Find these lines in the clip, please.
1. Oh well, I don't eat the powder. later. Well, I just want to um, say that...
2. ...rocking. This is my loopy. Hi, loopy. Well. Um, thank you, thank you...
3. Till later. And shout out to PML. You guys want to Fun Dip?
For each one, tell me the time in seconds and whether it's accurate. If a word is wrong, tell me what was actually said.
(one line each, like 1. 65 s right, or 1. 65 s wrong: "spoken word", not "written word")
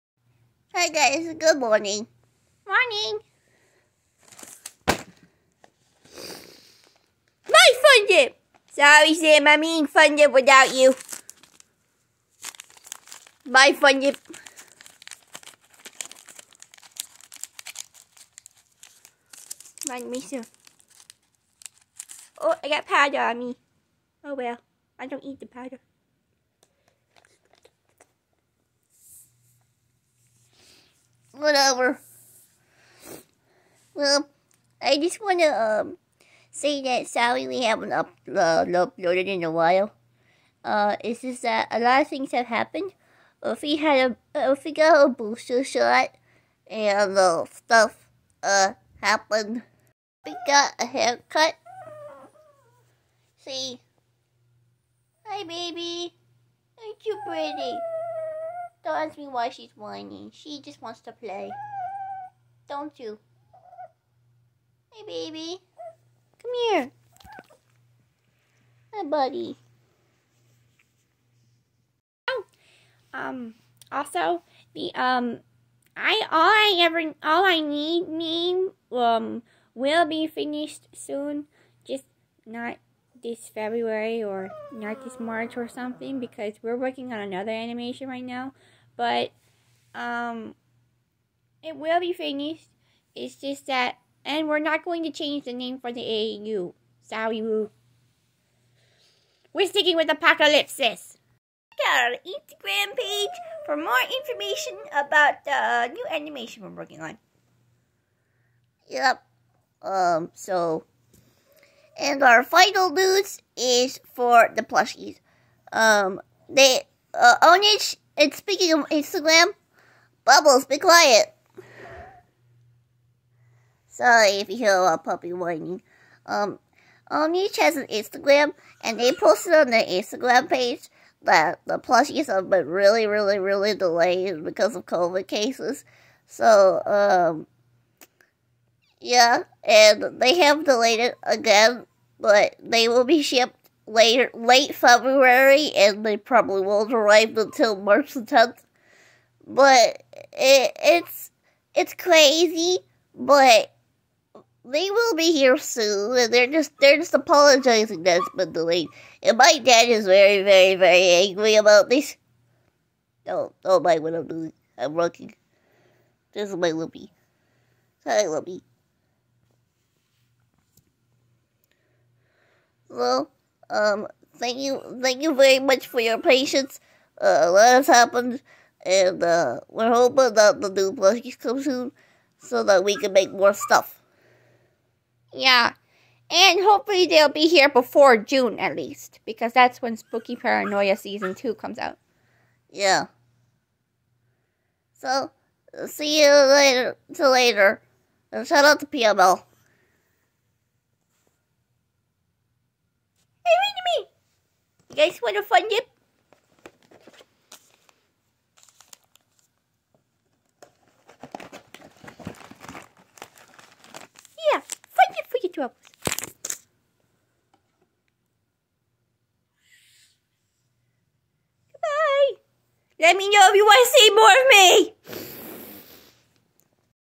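1. 24 s wrong: "whatever", not "later"
2. 164 s right
3. 197 s right.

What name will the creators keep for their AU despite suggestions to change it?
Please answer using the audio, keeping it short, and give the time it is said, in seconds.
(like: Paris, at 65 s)
Apocalypsis, at 100 s.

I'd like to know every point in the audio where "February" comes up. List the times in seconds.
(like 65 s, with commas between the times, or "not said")
83 s, 144 s.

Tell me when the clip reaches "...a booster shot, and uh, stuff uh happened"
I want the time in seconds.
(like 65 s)
45 s.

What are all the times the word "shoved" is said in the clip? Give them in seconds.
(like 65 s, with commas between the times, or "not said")
not said.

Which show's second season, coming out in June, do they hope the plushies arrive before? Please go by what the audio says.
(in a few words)
Spooky Paranoia.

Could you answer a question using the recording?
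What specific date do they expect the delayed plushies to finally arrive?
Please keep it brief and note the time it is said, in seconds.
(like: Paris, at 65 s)
March 10, at 147 s.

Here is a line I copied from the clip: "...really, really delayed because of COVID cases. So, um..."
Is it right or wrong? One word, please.
right.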